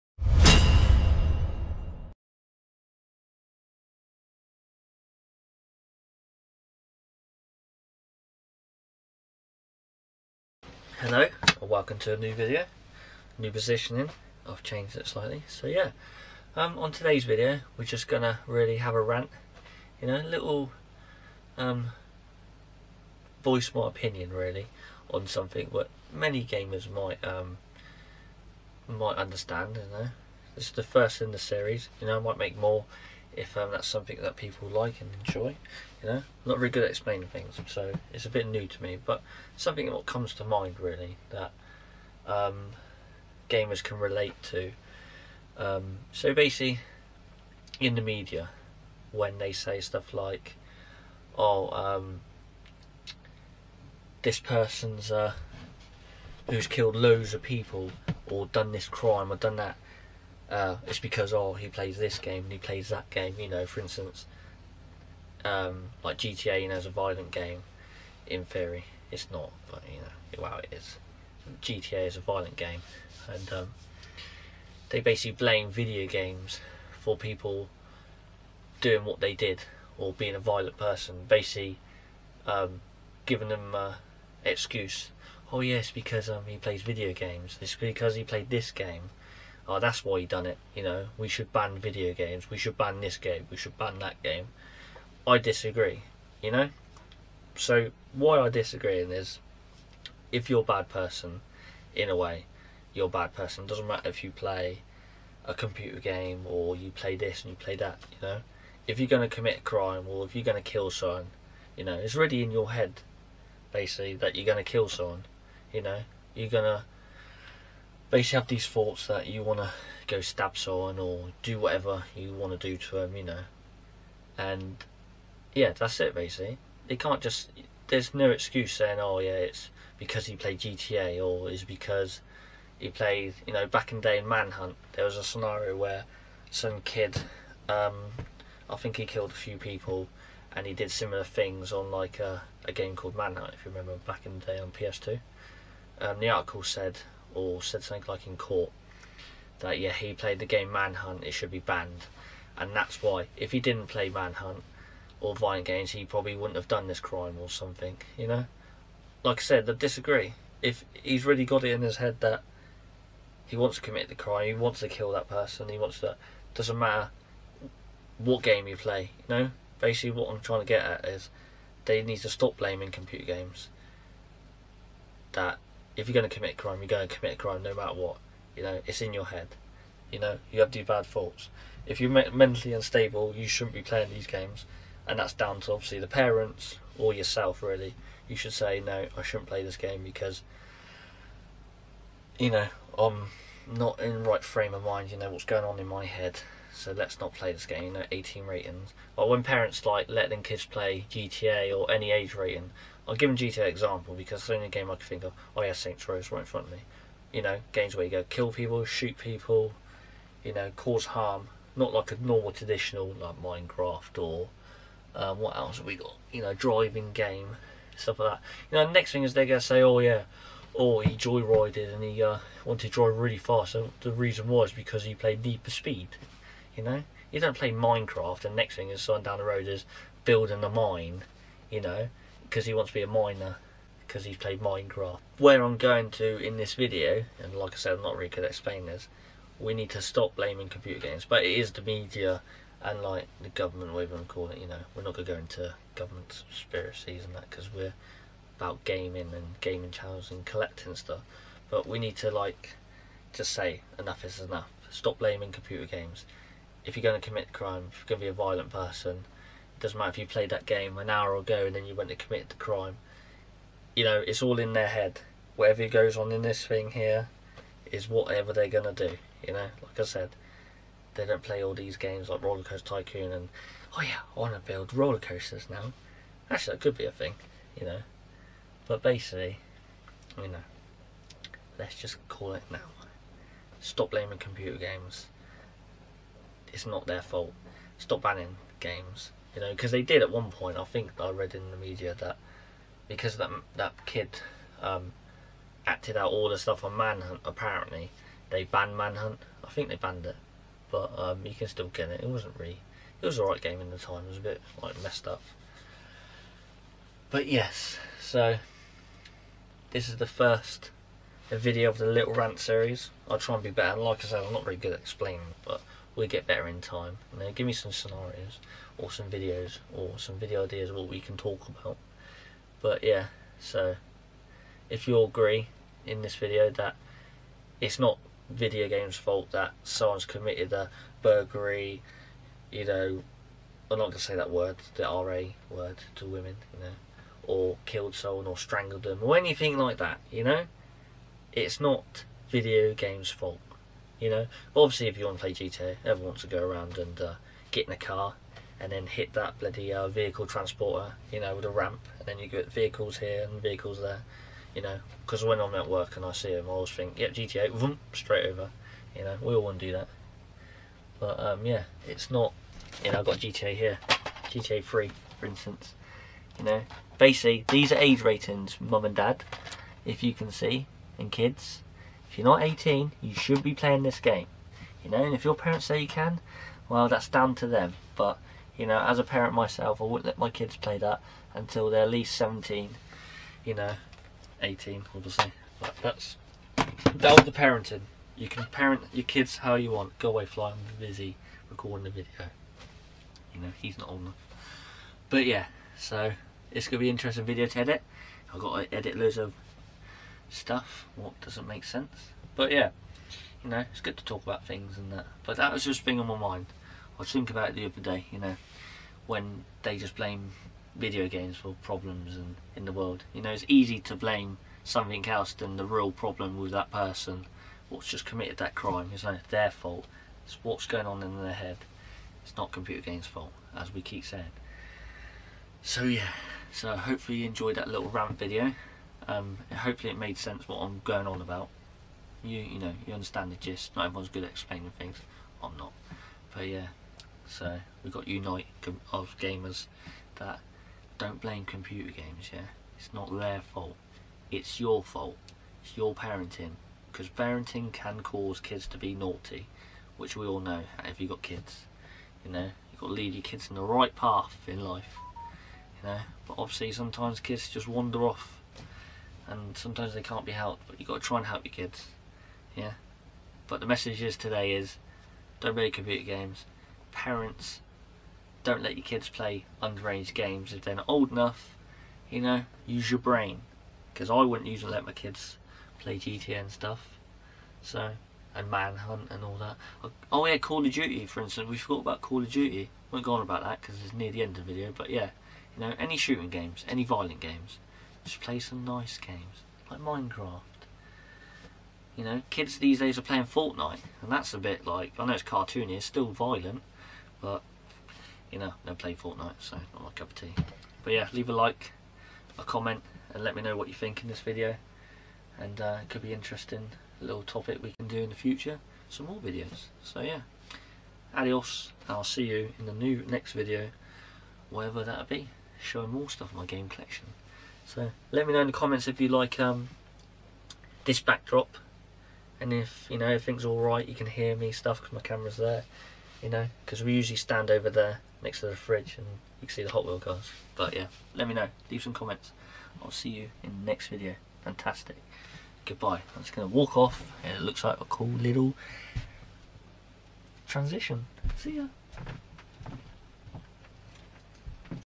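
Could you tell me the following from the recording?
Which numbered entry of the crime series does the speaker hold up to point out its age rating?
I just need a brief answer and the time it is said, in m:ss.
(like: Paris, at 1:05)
GTA 3, at 6:04.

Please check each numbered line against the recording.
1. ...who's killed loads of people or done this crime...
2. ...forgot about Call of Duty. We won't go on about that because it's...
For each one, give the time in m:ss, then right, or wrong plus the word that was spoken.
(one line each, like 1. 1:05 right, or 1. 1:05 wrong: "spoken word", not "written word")
1. 0:56 right
2. 8:01 right.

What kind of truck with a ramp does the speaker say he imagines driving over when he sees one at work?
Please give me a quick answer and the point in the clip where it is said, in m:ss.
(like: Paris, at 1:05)
vehicle transporter, at 5:50.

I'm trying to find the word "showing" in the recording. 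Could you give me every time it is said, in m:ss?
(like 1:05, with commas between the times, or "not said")
8:35.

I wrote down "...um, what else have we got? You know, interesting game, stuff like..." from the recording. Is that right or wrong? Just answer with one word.
wrong.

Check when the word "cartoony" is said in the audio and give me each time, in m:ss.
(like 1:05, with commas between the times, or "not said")
8:15.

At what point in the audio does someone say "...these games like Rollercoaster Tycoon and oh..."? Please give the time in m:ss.
4:31.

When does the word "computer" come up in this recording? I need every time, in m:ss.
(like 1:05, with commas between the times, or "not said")
1:45, 2:52, 4:00, 4:15, 4:44, 7:02, 7:21, 7:45.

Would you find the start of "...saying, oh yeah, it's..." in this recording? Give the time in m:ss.
2:08.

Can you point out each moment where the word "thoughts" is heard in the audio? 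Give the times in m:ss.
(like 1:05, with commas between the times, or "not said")
1:58, 3:01.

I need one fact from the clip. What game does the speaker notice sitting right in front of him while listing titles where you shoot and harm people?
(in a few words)
Saints Row.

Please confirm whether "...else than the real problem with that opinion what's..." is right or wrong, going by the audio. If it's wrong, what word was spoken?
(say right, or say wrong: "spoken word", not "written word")
wrong: "person", not "opinion".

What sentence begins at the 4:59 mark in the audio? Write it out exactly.
I think they banned it, but um, you can still get it.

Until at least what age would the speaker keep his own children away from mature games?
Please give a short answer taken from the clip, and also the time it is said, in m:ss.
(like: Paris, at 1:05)
17, at 6:22.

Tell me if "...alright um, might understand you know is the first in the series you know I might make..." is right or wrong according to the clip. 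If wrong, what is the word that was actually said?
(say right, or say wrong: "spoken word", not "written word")
wrong: "might", not "alright".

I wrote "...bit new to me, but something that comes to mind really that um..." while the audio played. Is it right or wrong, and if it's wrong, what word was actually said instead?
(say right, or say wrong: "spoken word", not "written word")
right.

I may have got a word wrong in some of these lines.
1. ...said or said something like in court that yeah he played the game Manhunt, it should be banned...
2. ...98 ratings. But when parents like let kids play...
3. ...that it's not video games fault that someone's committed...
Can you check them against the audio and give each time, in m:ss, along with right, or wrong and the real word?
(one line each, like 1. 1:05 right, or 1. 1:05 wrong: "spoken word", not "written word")
1. 2:26 right
2. 3:18 wrong: "18", not "98"
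3. 5:26 right.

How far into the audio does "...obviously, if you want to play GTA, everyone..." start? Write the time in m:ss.
5:44.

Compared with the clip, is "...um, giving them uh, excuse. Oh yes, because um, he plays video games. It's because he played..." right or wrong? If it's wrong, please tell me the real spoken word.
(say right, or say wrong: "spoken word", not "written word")
right.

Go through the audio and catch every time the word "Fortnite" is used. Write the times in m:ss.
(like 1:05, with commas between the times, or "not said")
8:13, 8:19.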